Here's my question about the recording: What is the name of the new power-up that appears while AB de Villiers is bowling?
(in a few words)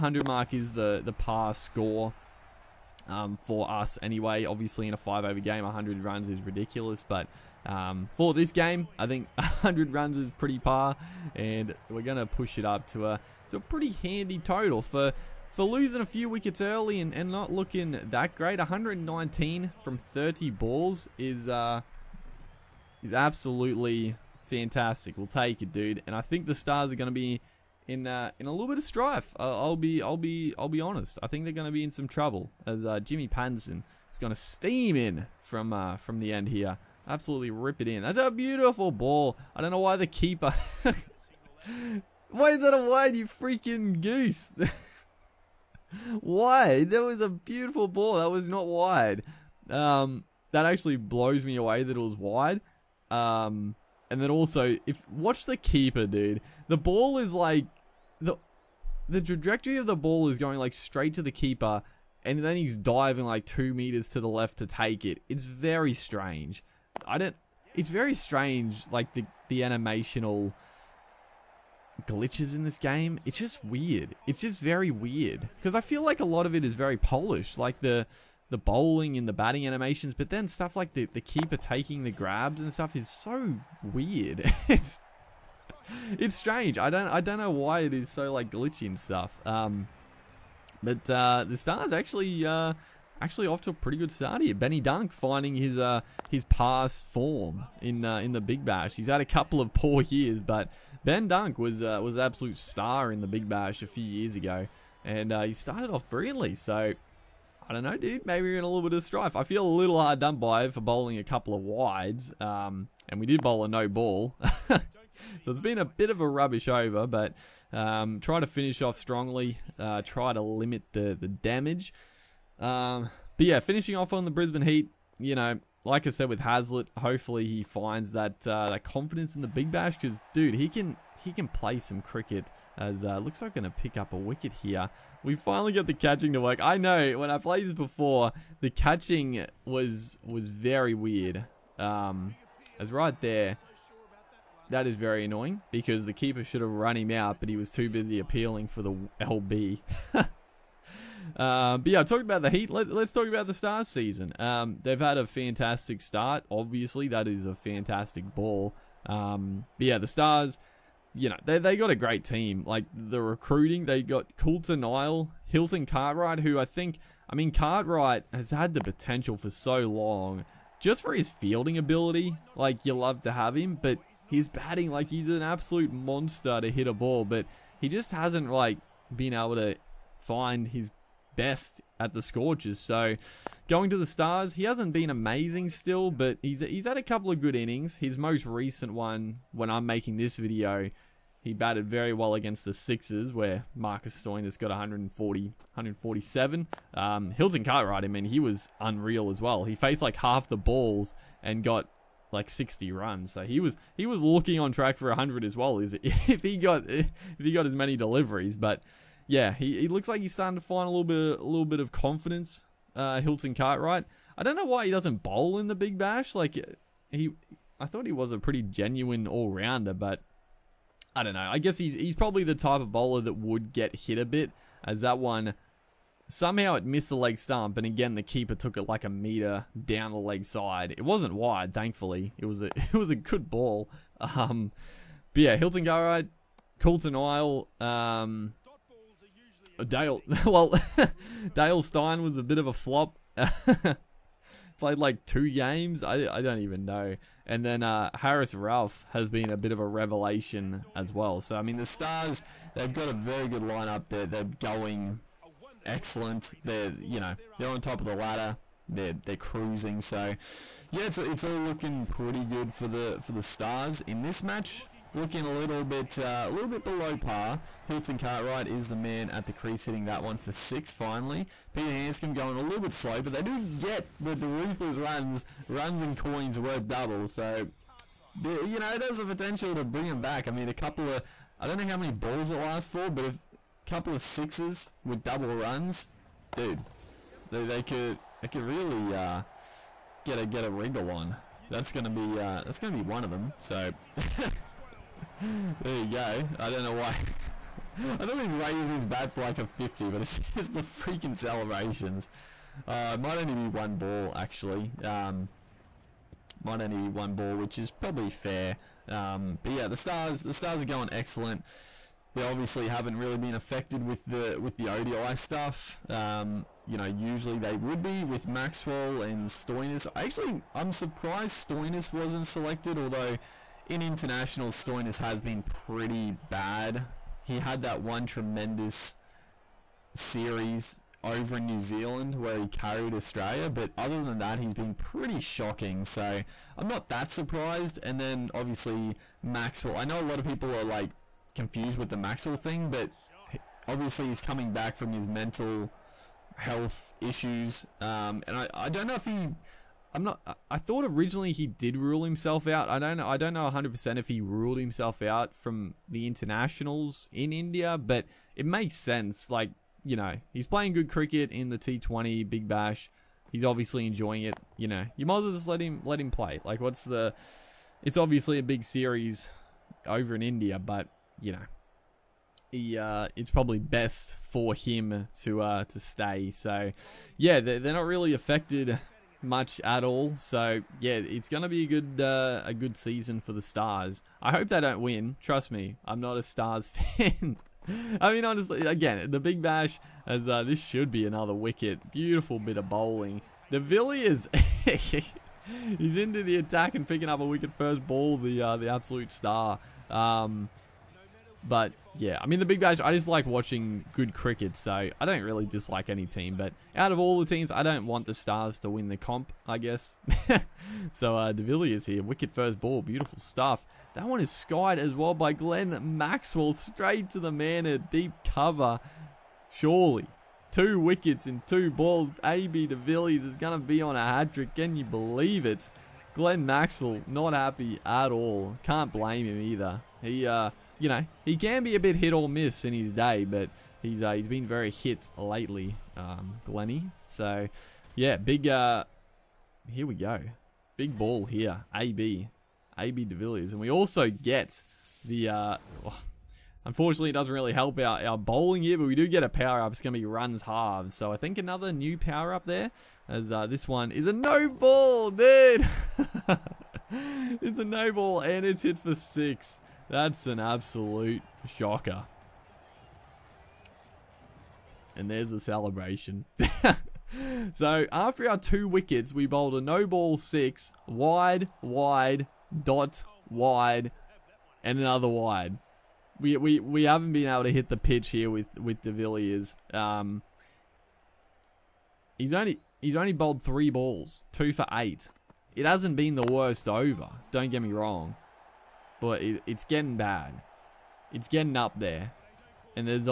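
Runs halves.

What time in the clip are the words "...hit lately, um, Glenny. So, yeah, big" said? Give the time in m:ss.
7:14.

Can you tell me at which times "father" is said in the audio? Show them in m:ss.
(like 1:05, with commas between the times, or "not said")
not said.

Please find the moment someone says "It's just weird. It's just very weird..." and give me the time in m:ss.
1:13.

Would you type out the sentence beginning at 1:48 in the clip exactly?
Maybe we're in a little bit of strife.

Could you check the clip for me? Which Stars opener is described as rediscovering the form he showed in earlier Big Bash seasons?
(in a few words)
Ben Dunk.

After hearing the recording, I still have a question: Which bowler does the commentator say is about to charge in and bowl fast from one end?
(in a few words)
Jimmy Panson.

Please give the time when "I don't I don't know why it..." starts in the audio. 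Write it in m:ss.
1:26.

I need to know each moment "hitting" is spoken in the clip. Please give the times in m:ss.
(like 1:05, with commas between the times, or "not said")
4:29.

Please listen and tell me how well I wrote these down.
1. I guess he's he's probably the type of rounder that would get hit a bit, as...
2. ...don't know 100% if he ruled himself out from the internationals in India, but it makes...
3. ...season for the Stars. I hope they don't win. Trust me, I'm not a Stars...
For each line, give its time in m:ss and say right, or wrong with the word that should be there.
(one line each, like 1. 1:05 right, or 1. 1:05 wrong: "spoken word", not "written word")
1. 3:41 wrong: "bowler", not "rounder"
2. 5:53 right
3. 6:22 right.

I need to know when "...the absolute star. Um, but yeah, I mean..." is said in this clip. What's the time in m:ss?
6:38.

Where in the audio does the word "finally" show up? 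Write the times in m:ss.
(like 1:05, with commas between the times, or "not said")
2:15, 4:30.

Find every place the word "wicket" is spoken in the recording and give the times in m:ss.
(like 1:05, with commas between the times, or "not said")
0:16, 2:14, 6:31, 6:37, 6:52, 7:00, 7:48.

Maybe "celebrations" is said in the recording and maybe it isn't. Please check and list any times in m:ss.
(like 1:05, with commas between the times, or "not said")
5:01, 7:45.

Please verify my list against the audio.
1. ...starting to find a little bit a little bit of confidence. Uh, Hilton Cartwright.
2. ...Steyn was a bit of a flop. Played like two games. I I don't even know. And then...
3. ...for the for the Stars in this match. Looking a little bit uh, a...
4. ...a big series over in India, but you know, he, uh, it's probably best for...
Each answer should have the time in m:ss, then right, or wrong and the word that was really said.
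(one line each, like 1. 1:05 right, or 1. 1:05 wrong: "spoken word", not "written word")
1. 3:30 right
2. 4:01 right
3. 4:22 right
4. 6:08 right.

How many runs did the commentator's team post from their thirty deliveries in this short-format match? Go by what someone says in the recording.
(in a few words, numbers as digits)
119.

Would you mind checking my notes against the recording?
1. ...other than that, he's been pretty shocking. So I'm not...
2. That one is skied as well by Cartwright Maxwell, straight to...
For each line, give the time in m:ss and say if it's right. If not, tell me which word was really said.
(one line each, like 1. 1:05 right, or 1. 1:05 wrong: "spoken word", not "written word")
1. 5:33 right
2. 6:54 wrong: "Glenn", not "Cartwright".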